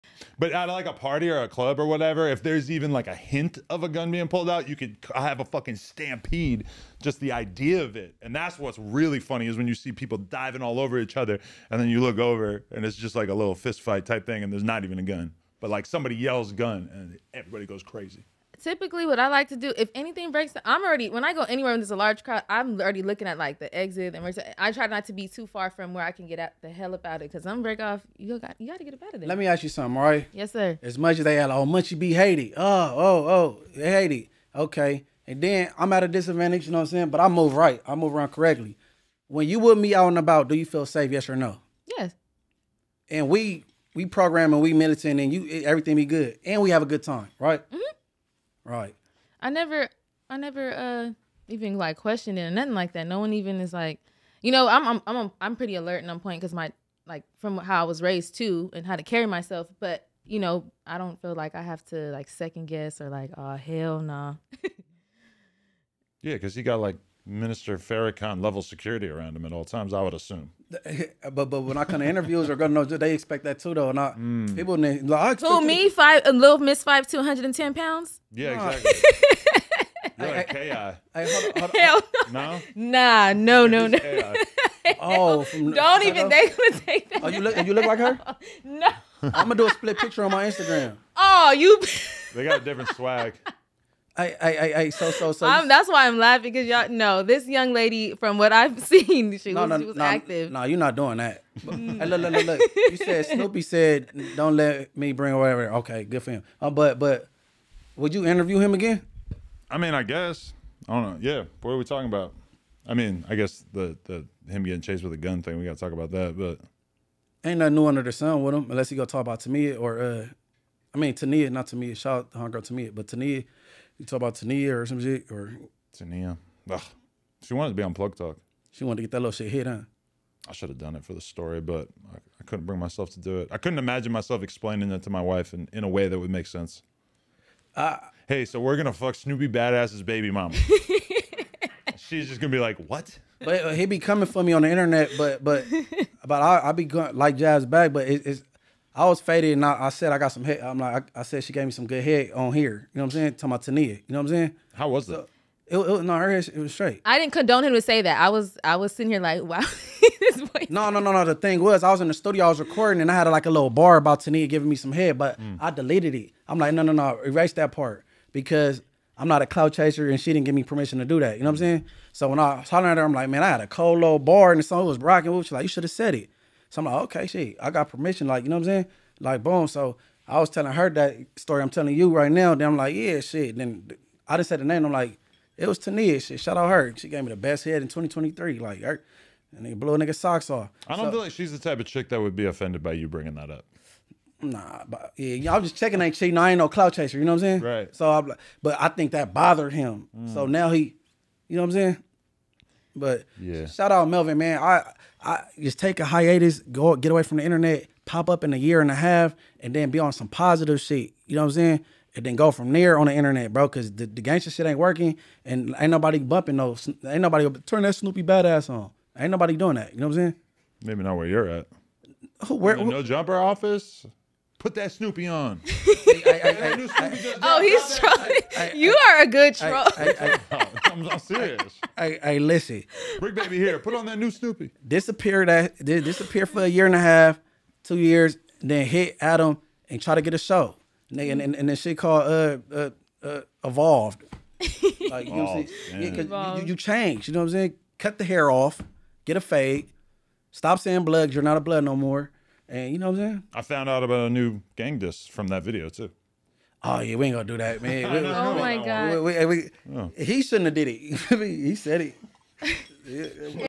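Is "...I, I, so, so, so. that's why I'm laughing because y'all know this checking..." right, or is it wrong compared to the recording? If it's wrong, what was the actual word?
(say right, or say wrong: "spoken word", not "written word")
wrong: "young", not "checking".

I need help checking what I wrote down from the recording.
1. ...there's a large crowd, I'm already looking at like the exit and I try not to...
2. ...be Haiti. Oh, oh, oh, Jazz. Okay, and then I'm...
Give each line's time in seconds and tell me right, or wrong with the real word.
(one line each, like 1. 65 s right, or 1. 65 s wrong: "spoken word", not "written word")
1. 21 s right
2. 31 s wrong: "Haiti", not "Jazz".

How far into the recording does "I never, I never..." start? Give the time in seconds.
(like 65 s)
49 s.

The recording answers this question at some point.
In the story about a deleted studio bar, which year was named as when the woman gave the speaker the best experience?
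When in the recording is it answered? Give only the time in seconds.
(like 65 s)
187 s.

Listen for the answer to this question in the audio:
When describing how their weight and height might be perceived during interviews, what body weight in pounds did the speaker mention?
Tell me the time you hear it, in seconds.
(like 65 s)
77 s.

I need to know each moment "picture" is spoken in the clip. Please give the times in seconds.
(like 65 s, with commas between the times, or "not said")
89 s.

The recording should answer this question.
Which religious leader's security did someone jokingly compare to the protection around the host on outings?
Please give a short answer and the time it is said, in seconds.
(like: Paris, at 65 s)
Minister Farrakhan, at 67 s.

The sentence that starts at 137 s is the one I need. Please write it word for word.
Uh, hey, so we're gonna fuck Snoopy Badazz's baby mama.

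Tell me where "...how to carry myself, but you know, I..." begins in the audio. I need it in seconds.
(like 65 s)
58 s.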